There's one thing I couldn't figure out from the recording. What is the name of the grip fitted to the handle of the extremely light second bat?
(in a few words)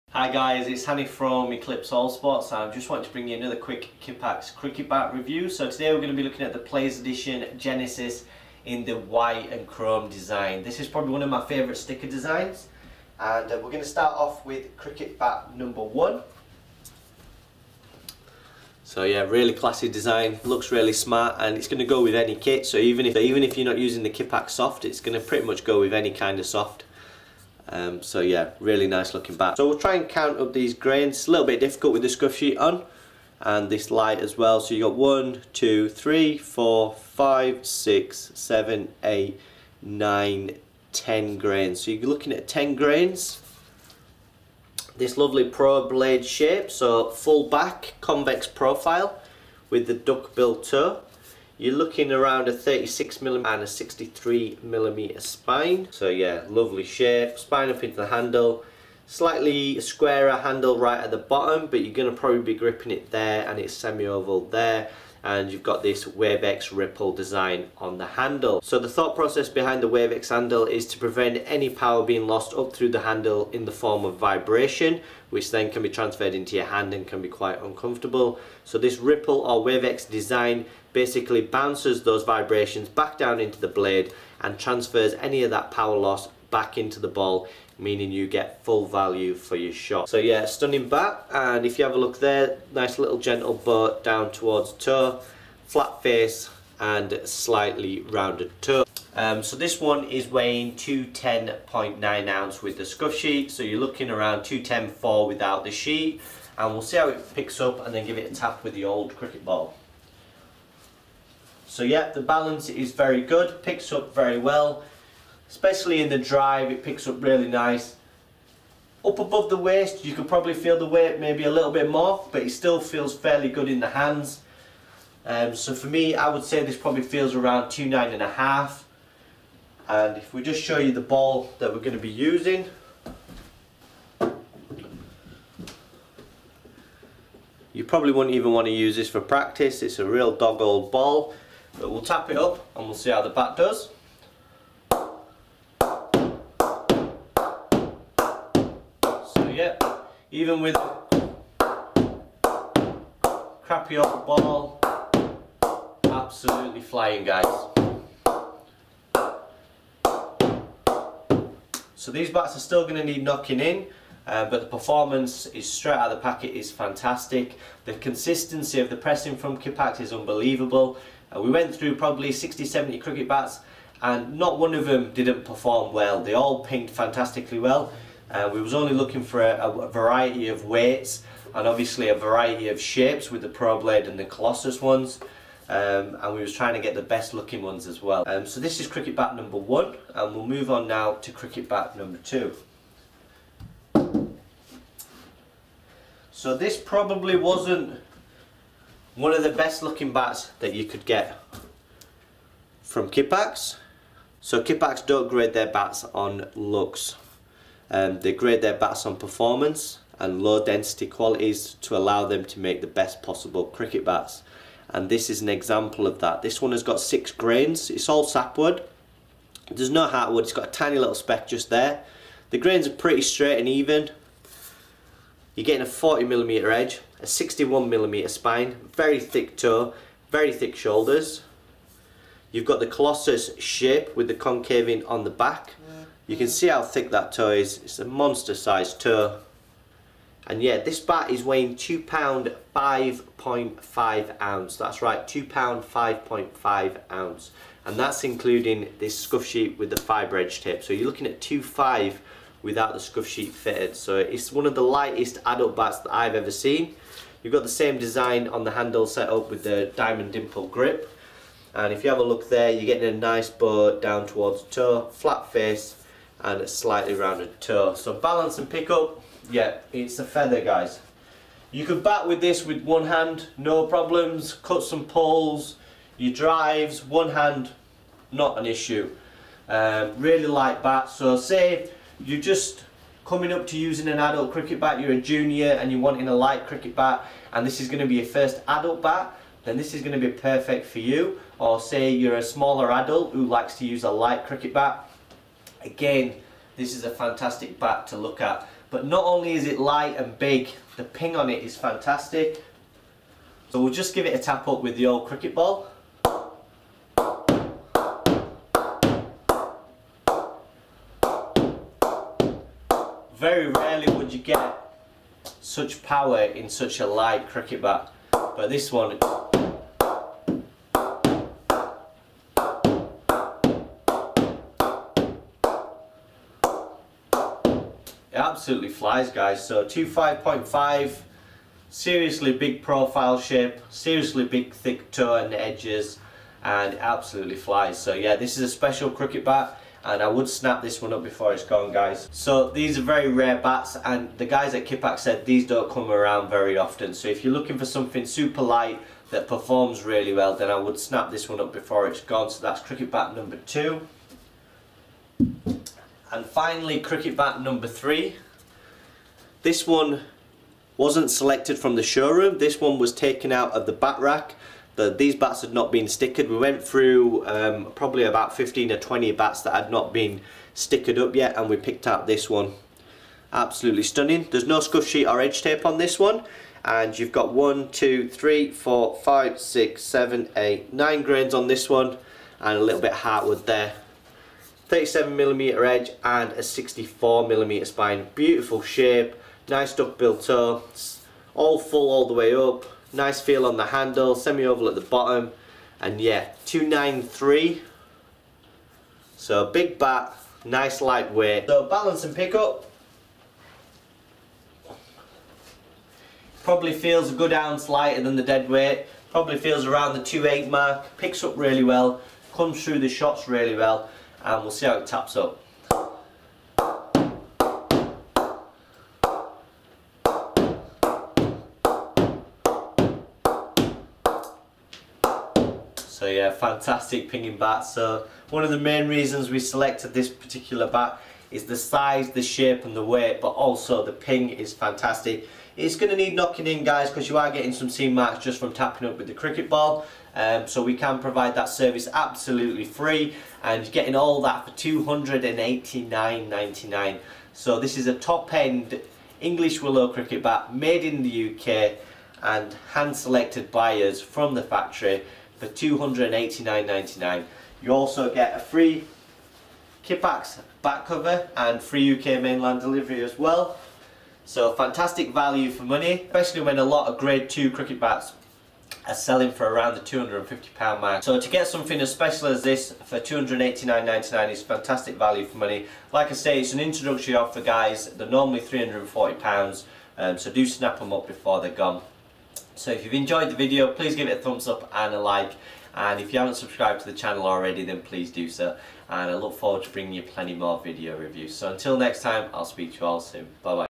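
diamond dimple grip.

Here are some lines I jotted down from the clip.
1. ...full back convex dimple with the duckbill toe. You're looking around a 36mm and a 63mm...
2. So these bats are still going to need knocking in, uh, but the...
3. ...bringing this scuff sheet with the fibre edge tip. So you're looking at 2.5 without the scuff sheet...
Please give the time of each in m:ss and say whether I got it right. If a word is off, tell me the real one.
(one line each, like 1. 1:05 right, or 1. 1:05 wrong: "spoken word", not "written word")
1. 0:47 wrong: "profile", not "dimple"
2. 2:41 right
3. 4:08 wrong: "including", not "bringing".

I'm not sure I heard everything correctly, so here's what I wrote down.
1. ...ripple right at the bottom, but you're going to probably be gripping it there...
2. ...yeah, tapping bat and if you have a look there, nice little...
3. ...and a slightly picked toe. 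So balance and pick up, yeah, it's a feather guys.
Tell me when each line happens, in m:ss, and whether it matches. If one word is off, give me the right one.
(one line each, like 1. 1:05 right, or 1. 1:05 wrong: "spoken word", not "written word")
1. 1:00 wrong: "handle", not "ripple"
2. 1:30 wrong: "stunning", not "tapping"
3. 4:26 wrong: "rounded", not "picked".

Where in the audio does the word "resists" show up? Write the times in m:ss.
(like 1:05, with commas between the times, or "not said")
not said.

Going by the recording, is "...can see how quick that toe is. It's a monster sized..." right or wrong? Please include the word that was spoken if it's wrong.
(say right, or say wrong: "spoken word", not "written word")
wrong: "thick", not "quick".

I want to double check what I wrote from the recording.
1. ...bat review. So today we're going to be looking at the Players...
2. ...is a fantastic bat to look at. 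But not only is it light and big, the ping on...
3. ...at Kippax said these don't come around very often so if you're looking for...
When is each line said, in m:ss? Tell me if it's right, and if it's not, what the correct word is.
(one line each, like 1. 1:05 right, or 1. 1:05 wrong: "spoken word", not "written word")
1. 0:04 right
2. 4:56 right
3. 5:44 right.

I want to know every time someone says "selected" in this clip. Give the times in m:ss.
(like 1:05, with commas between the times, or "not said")
6:01, 7:09, 7:33.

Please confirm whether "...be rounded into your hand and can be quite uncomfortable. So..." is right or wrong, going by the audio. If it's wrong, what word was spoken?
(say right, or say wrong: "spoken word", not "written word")
wrong: "transferred", not "rounded".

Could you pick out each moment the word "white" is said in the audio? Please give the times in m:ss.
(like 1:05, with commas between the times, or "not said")
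0:08.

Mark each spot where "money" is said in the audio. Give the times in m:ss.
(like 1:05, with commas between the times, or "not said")
7:45, 7:55.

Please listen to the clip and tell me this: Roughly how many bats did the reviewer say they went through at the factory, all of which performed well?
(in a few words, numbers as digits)
60-70.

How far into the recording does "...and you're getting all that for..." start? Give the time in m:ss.
7:23.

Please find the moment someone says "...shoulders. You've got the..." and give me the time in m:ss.
3:50.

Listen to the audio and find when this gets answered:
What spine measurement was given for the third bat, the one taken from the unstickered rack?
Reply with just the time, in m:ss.
6:26.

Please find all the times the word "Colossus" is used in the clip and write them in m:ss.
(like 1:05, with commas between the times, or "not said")
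3:04, 3:52.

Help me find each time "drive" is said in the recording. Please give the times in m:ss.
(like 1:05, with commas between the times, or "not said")
1:56, 4:36.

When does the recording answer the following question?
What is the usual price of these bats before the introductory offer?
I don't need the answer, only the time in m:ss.
7:58.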